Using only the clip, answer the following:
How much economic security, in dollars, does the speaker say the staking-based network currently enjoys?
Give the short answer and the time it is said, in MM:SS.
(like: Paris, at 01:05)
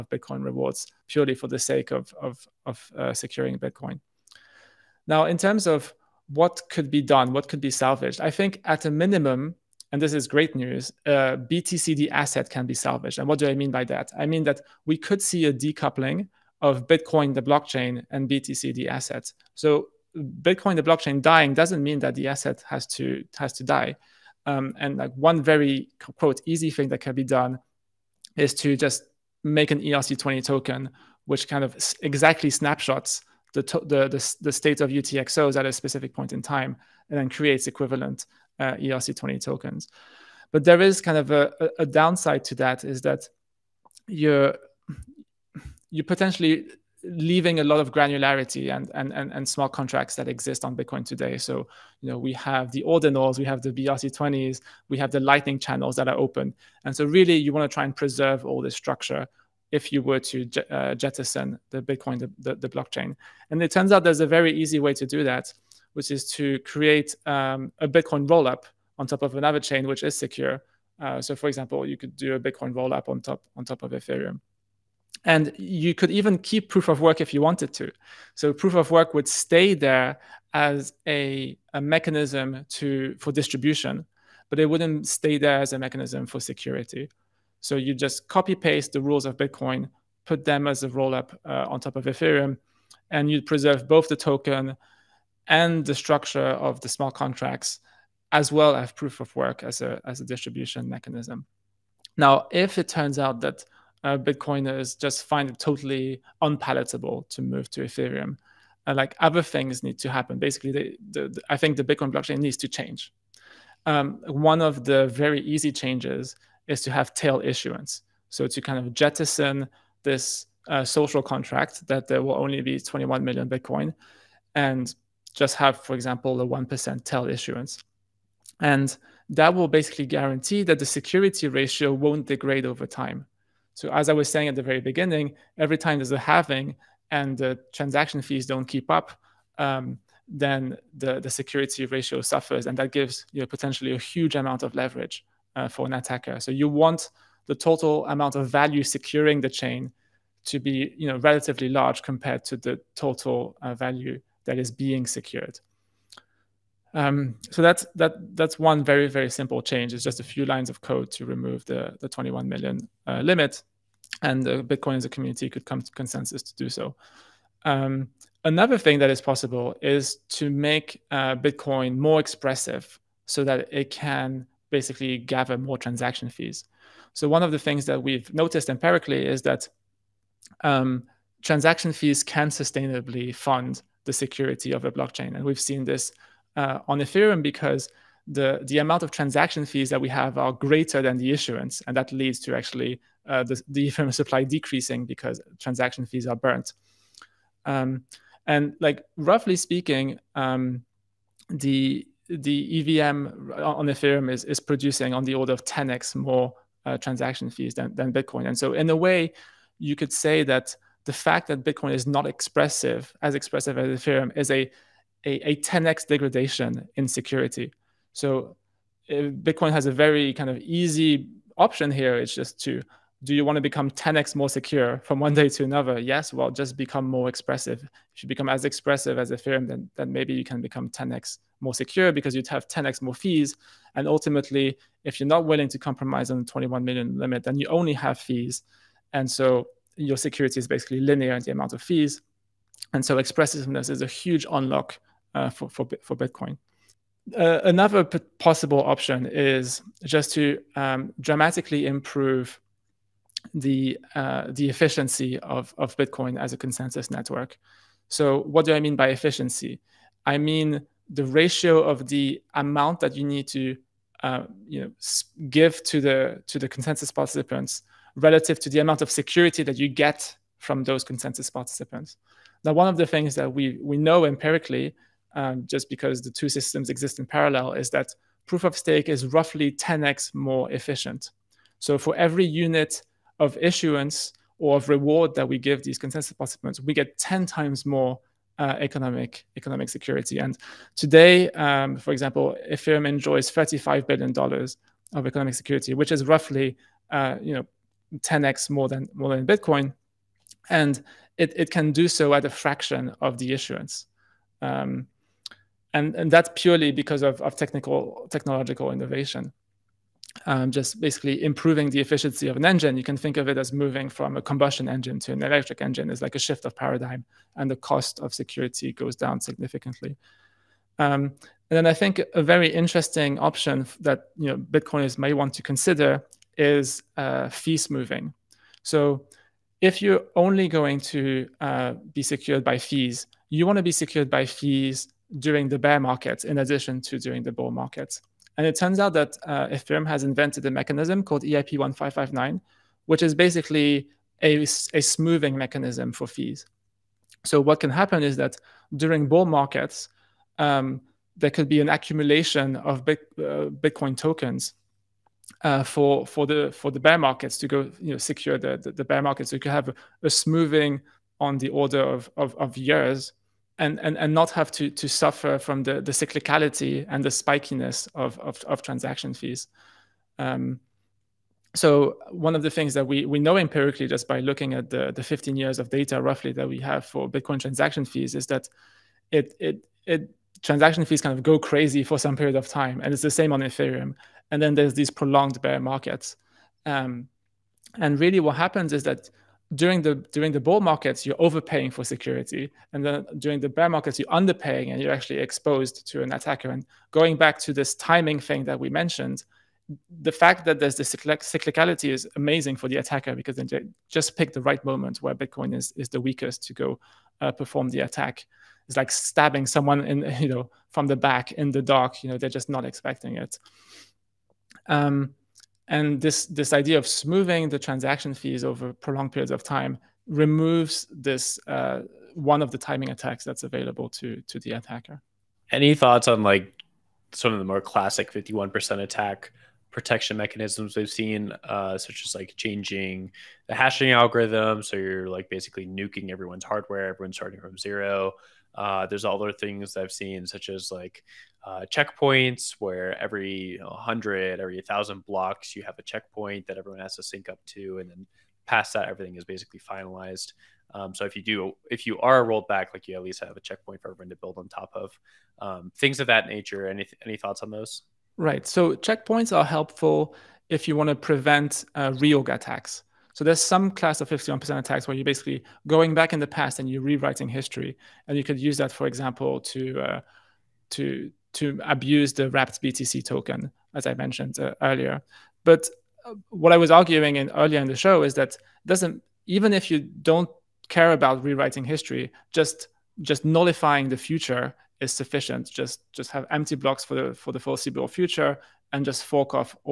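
35 billion dollars, at 04:53.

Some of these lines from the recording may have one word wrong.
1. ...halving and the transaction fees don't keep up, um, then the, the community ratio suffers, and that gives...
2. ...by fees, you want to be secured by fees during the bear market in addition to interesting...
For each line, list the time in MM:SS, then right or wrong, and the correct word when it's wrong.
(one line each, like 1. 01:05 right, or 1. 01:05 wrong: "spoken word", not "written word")
1. 02:16 wrong: "security", not "community"
2. 05:32 wrong: "during", not "interesting".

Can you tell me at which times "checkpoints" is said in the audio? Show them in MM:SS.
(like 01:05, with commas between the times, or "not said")
07:21, 07:26, 07:33, 07:38.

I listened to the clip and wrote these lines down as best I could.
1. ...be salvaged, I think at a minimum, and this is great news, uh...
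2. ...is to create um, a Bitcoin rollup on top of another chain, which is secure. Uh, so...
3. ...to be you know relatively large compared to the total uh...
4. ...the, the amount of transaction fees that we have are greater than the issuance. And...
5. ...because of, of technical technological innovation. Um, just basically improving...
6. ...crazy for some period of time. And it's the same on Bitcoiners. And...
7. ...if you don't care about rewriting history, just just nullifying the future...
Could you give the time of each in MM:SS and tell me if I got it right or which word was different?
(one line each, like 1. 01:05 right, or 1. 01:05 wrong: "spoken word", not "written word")
1. 00:07 right
2. 01:06 right
3. 02:30 right
4. 03:08 right
5. 05:07 right
6. 06:21 wrong: "Ethereum", not "Bitcoiners"
7. 07:59 right.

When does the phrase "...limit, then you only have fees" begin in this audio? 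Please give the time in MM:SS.
03:57.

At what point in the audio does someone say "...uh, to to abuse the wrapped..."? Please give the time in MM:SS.
07:50.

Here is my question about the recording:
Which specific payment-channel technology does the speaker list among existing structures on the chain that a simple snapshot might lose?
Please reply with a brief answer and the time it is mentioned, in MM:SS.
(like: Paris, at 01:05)
lightning channels, at 00:55.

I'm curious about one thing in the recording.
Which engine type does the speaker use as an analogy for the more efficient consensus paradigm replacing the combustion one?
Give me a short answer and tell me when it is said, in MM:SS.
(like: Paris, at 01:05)
electric engine, at 05:15.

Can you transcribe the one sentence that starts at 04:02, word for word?
And so expressiveness is a huge unlock uh, for, for, for Bitcoin.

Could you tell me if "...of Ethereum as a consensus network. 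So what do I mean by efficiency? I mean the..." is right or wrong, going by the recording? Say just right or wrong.
wrong.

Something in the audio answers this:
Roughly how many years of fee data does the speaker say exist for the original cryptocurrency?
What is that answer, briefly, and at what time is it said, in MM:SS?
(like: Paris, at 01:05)
15, at 06:15.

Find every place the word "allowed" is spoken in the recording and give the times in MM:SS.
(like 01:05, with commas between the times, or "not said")
not said.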